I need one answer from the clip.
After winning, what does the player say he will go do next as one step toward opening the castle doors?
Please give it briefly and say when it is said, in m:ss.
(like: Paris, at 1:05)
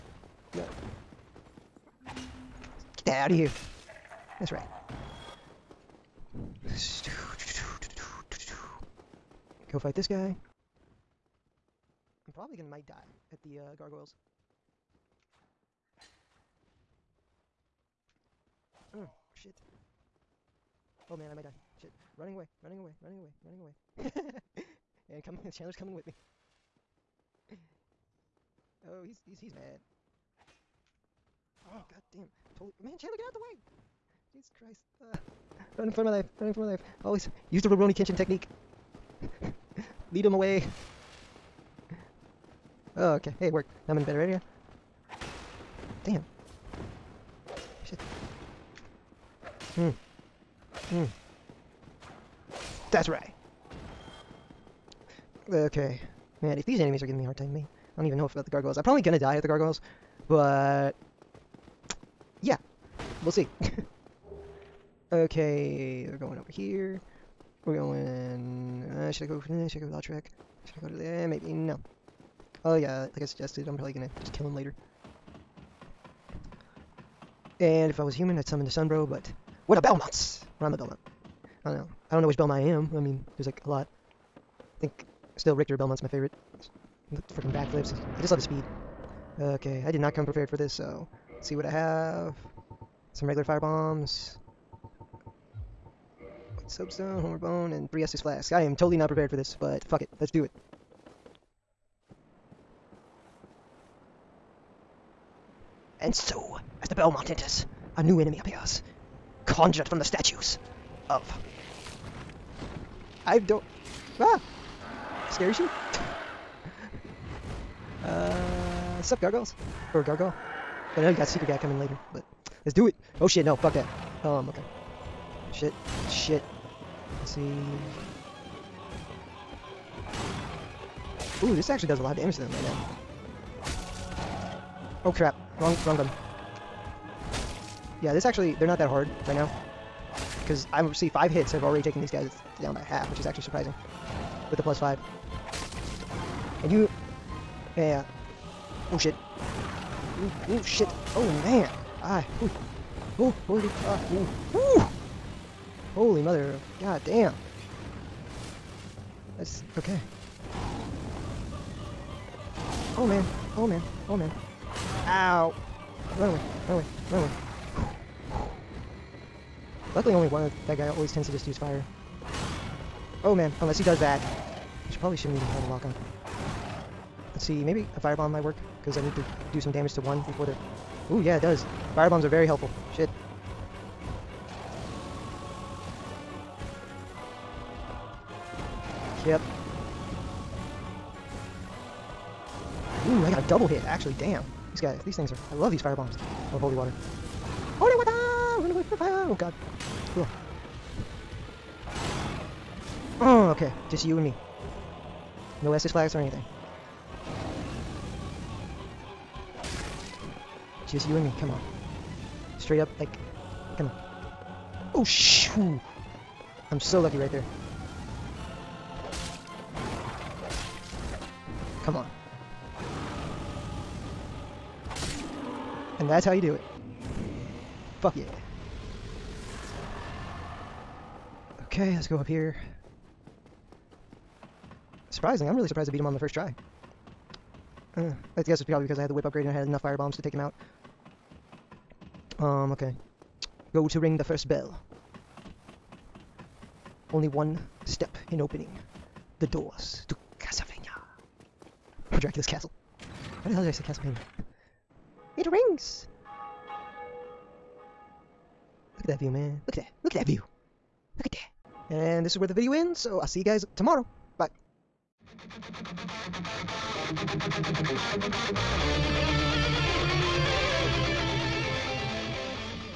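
Ring the first bell, at 4:03.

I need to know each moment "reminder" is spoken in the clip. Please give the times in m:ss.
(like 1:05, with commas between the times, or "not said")
not said.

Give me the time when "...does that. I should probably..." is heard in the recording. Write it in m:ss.
2:53.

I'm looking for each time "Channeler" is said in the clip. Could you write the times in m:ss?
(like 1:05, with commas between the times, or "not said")
0:25, 0:32.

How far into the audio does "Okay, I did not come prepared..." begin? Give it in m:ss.
1:29.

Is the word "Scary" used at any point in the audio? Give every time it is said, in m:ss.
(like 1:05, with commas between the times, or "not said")
1:55.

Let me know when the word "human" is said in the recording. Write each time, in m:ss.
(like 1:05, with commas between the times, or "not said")
1:18.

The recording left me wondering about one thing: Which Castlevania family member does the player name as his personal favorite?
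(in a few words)
Richter Belmont.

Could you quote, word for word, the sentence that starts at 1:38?
I am totally not prepared for this, but fuck it.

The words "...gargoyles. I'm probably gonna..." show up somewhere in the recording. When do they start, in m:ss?
0:58.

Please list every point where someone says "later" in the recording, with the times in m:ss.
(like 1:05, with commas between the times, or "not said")
1:14, 2:01.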